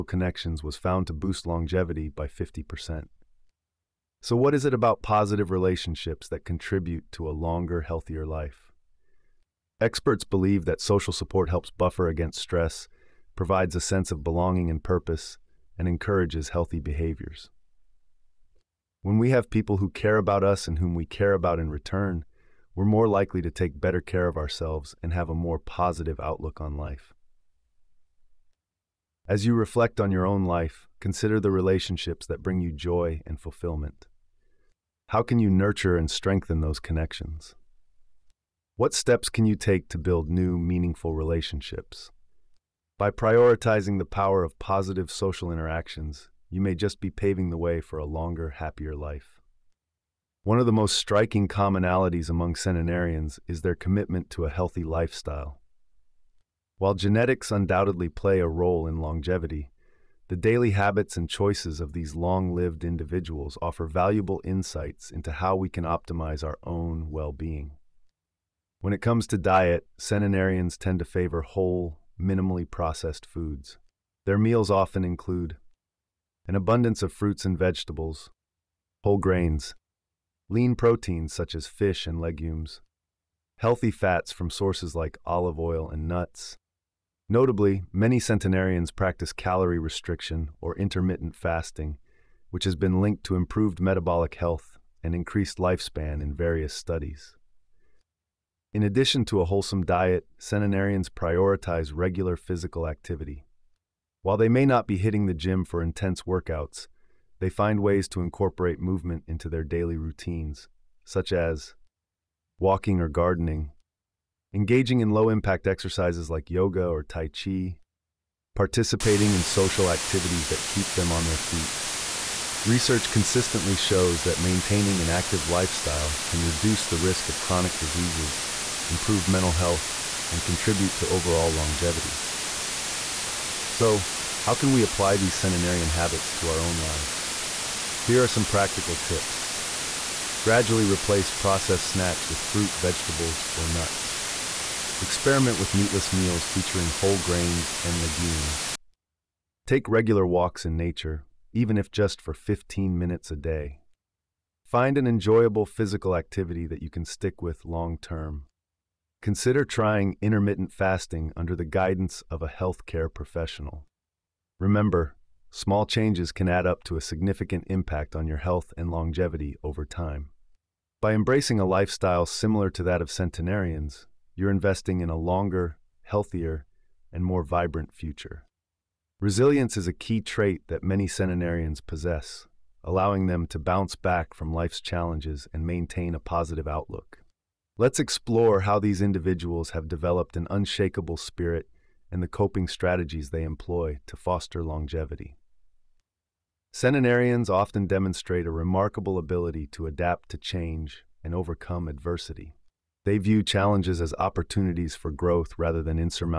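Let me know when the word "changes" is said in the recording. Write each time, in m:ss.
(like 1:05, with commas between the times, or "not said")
2:45, 3:20.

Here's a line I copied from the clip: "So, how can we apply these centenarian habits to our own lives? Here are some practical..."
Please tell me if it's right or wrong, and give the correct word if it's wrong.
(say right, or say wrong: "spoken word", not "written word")
right.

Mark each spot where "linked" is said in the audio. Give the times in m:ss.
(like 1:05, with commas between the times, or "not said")
1:33.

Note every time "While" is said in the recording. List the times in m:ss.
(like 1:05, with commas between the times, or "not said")
0:56, 1:44.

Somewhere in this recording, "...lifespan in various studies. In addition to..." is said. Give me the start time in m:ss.
1:35.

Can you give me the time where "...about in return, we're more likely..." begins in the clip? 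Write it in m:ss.
0:21.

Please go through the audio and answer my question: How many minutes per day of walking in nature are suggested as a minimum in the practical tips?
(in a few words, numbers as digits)
15.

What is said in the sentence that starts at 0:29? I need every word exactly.
As you reflect on your own life, consider the relationships that bring you joy and fulfillment.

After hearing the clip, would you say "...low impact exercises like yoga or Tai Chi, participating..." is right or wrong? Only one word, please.
right.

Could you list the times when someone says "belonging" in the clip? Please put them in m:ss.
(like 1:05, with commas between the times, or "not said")
0:14.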